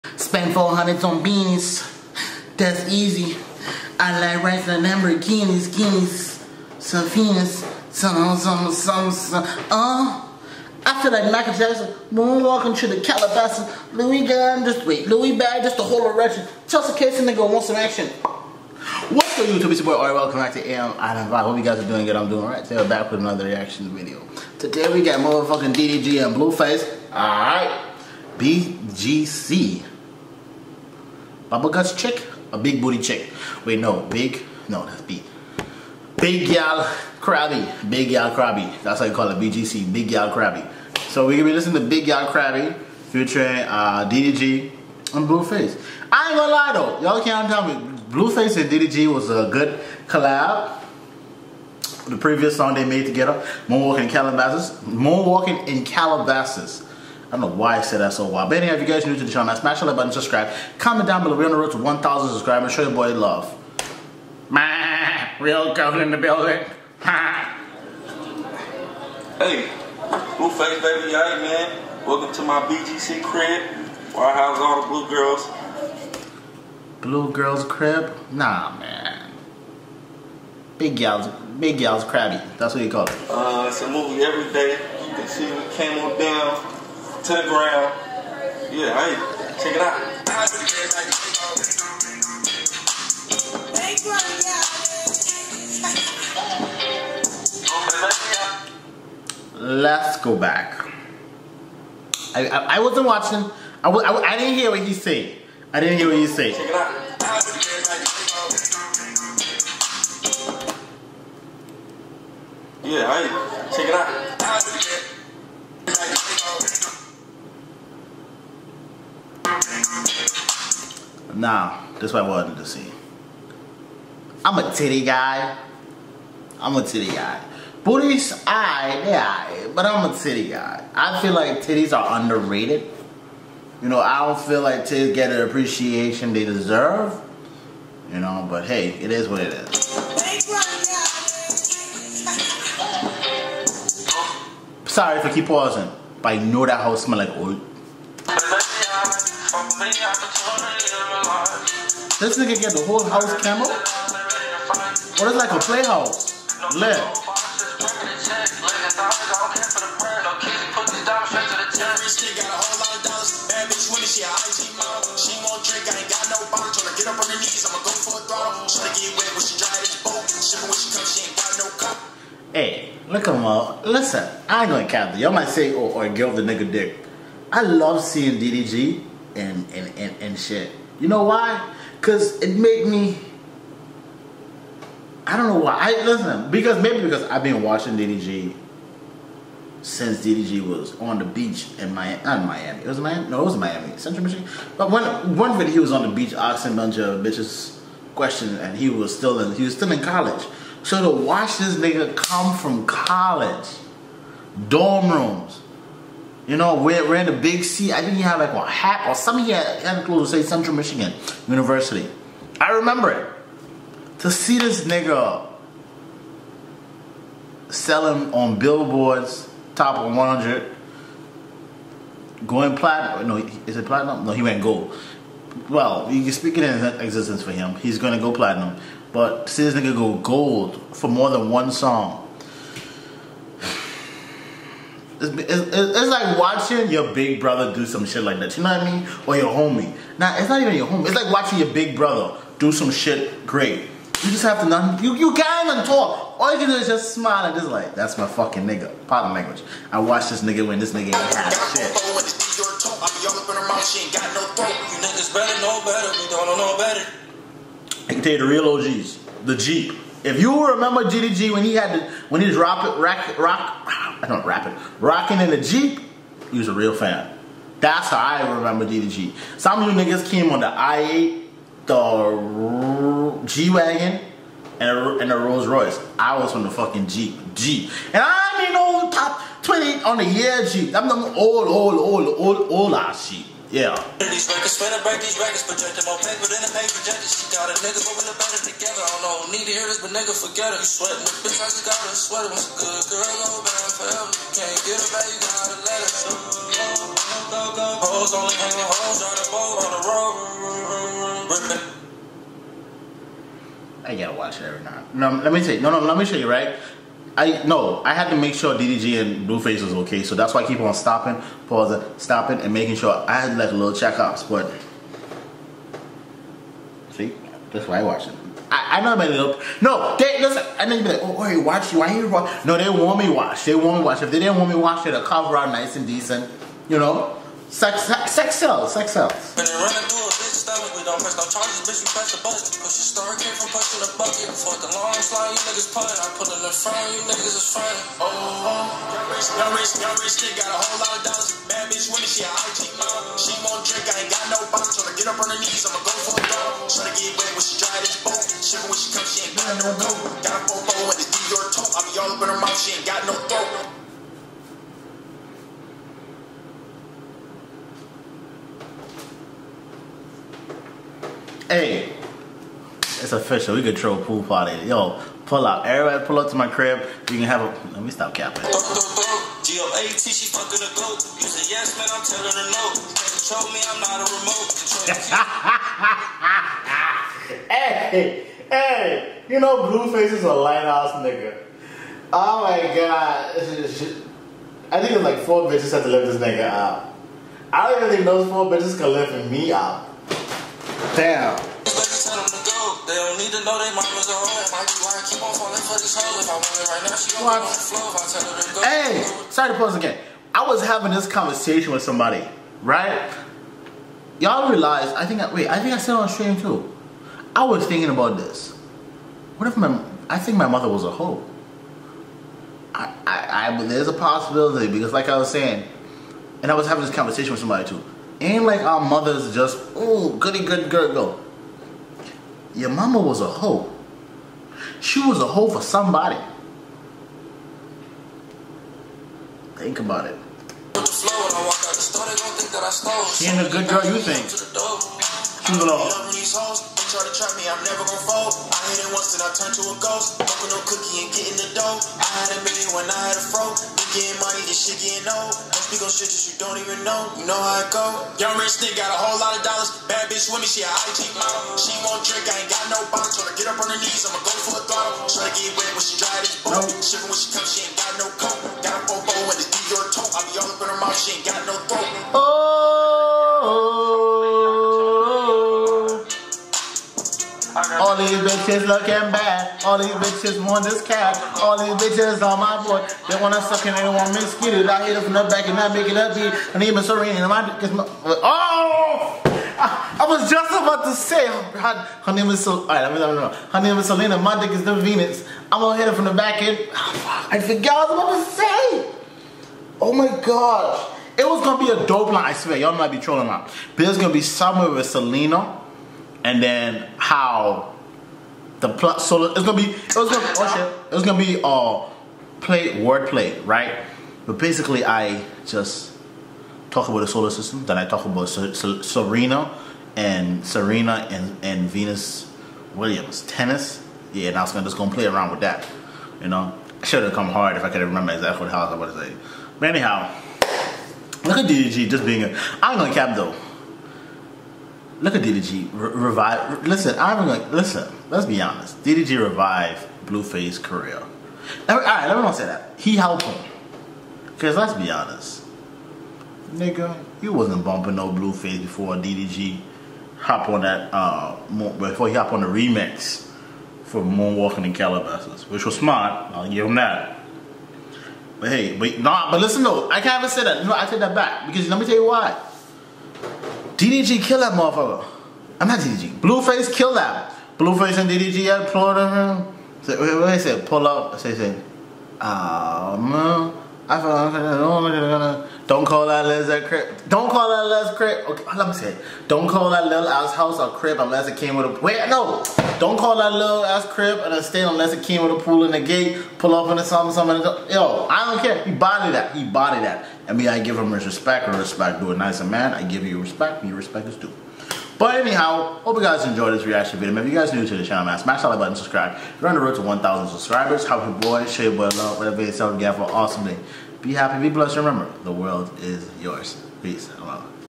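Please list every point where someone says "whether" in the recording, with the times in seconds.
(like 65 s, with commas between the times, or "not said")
not said.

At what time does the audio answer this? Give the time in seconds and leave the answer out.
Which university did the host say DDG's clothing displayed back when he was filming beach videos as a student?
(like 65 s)
210 s.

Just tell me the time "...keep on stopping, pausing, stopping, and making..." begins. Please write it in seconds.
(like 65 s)
310 s.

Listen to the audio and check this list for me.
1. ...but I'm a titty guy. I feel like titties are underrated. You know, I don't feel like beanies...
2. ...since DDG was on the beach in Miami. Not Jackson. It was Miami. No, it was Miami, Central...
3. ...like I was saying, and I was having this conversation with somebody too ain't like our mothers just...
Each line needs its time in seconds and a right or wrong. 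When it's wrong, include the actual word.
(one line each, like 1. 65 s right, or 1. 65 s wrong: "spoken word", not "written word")
1. 129 s wrong: "titties", not "beanies"
2. 189 s wrong: "Miami", not "Jackson"
3. 415 s right.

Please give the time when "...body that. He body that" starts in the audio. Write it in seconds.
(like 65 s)
578 s.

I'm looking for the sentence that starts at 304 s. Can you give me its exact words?
I gotta watch it every night.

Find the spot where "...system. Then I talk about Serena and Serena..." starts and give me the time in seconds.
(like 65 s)
507 s.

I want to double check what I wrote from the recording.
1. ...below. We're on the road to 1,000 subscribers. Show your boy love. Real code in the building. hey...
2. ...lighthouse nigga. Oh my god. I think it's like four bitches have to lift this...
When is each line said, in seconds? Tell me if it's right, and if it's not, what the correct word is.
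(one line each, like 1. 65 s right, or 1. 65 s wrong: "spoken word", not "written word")
1. 61 s right
2. 380 s right.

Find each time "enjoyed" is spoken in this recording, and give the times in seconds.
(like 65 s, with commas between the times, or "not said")
586 s.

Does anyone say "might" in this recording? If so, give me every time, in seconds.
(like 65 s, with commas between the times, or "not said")
175 s, 492 s.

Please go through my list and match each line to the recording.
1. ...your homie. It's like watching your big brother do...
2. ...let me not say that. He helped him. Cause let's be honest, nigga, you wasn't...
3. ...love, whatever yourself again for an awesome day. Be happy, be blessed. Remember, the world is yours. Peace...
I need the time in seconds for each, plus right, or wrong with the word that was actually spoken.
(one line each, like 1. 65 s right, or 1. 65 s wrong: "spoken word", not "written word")
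1. 240 s right
2. 532 s right
3. 592 s right.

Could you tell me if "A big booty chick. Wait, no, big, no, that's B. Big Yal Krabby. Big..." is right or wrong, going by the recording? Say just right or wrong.
right.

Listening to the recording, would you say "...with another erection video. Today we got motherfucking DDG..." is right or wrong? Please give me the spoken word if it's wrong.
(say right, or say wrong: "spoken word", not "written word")
wrong: "reaction", not "erection".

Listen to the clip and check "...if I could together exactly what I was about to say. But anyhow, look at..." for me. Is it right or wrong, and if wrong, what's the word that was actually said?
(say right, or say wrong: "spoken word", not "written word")
wrong: "remember", not "together".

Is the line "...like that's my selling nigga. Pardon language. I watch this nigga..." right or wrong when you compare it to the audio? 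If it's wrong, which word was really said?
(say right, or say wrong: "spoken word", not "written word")
wrong: "fucking", not "selling".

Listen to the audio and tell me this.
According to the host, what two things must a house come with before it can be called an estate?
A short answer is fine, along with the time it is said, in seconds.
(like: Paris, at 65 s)
A pool and a gate, at 575 s.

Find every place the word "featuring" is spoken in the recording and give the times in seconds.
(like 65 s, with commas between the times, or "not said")
43 s.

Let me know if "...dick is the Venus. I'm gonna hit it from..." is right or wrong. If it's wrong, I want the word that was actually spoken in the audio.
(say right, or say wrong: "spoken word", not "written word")
right.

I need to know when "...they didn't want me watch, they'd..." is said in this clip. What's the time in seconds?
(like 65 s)
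324 s.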